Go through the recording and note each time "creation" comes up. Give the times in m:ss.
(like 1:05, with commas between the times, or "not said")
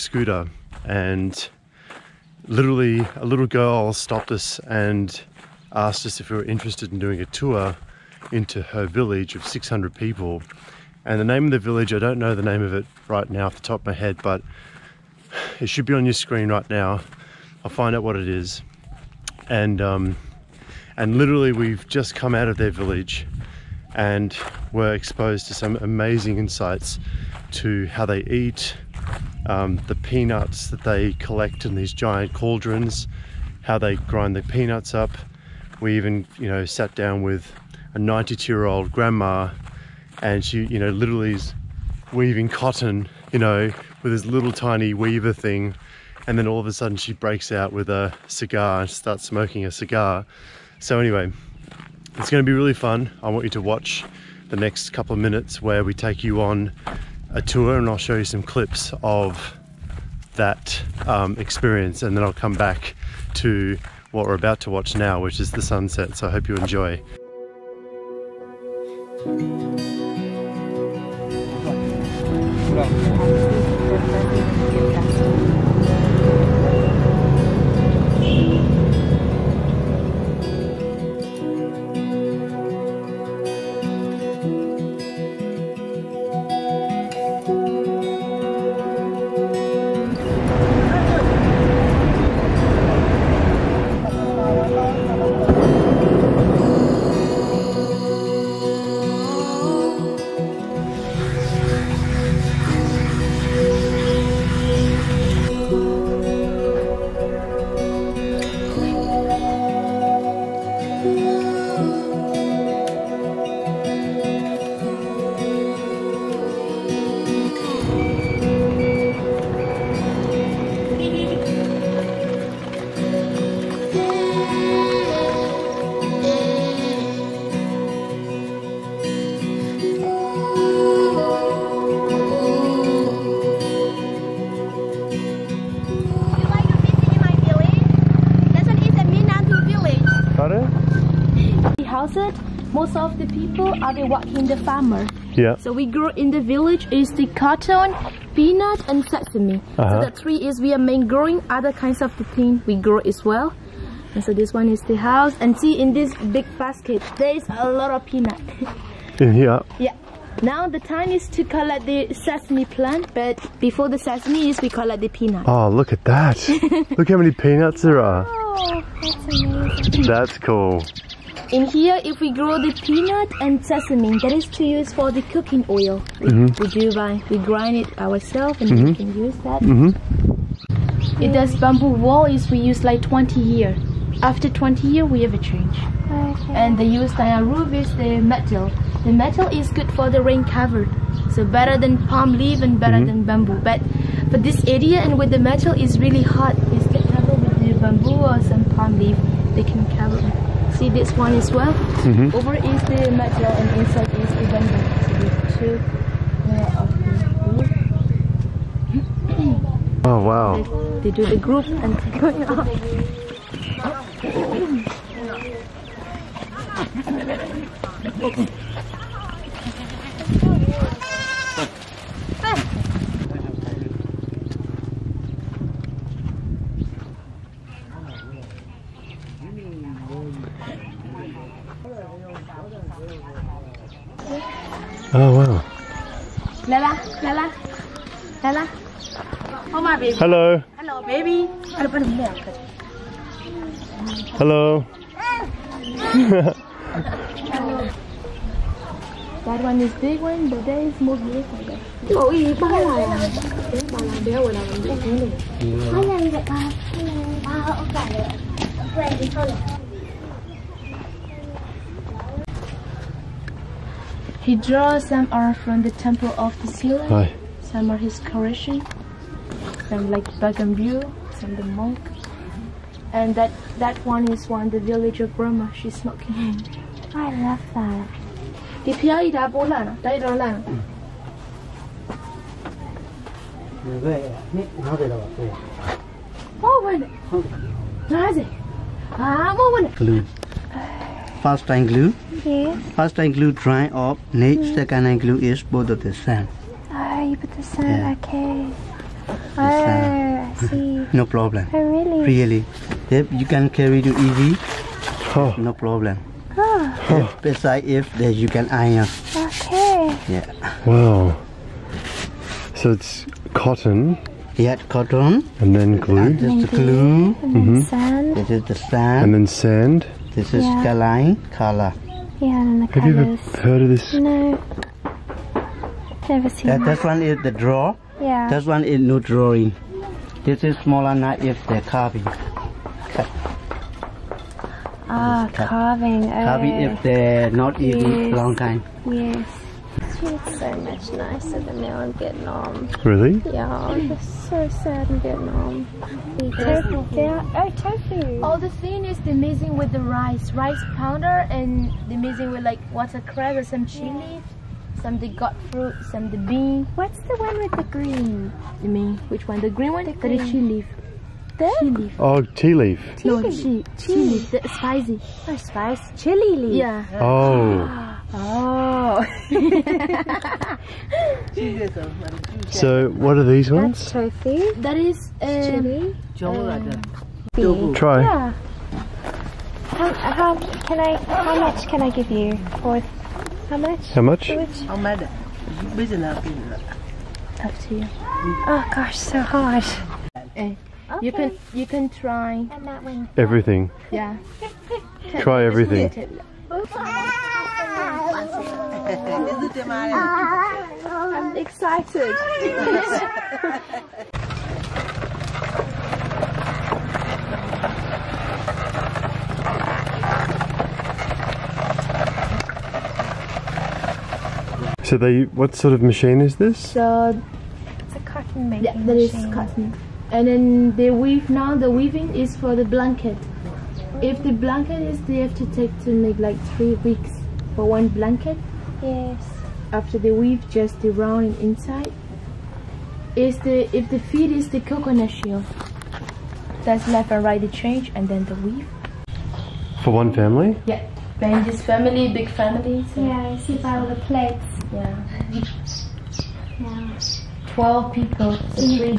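4:28.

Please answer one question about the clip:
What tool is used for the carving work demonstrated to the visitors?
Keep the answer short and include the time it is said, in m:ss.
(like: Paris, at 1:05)
smaller knife, at 5:30.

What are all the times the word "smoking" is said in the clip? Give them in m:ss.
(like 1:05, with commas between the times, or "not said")
0:49, 4:35.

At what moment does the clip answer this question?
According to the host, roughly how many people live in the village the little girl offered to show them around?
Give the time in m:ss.
0:09.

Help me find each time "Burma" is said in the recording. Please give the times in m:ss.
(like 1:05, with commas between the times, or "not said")
4:35.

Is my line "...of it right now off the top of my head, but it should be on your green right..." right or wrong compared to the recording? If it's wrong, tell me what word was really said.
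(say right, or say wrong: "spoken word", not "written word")
wrong: "screen", not "green".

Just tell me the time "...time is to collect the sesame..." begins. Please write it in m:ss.
2:40.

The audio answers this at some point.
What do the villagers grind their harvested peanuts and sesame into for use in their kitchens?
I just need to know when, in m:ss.
2:55.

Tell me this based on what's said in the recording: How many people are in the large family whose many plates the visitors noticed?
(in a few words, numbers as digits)
12.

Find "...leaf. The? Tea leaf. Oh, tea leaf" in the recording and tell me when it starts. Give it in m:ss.
6:00.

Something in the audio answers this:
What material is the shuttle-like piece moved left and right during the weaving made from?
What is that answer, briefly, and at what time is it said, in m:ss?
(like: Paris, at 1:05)
coconut shell, at 7:14.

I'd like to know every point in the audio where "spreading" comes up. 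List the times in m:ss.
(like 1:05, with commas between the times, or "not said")
not said.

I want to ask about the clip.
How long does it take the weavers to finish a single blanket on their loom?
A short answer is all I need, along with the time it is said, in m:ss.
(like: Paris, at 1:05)
3 weeks, at 7:06.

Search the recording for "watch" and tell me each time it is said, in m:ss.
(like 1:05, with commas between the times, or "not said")
0:53, 1:04.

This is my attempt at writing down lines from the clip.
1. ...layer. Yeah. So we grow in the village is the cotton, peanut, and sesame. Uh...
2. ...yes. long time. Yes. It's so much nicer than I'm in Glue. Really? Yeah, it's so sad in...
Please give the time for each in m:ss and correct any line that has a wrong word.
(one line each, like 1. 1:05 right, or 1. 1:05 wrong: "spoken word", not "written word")
1. 2:24 wrong: "farmer", not "layer"
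2. 5:37 wrong: "Vietnam", not "Glue".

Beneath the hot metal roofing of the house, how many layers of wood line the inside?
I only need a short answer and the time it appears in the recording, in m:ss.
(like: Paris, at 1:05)
2, at 3:25.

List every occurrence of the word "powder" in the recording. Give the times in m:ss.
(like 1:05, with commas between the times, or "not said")
5:50.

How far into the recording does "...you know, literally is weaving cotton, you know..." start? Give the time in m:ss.
0:40.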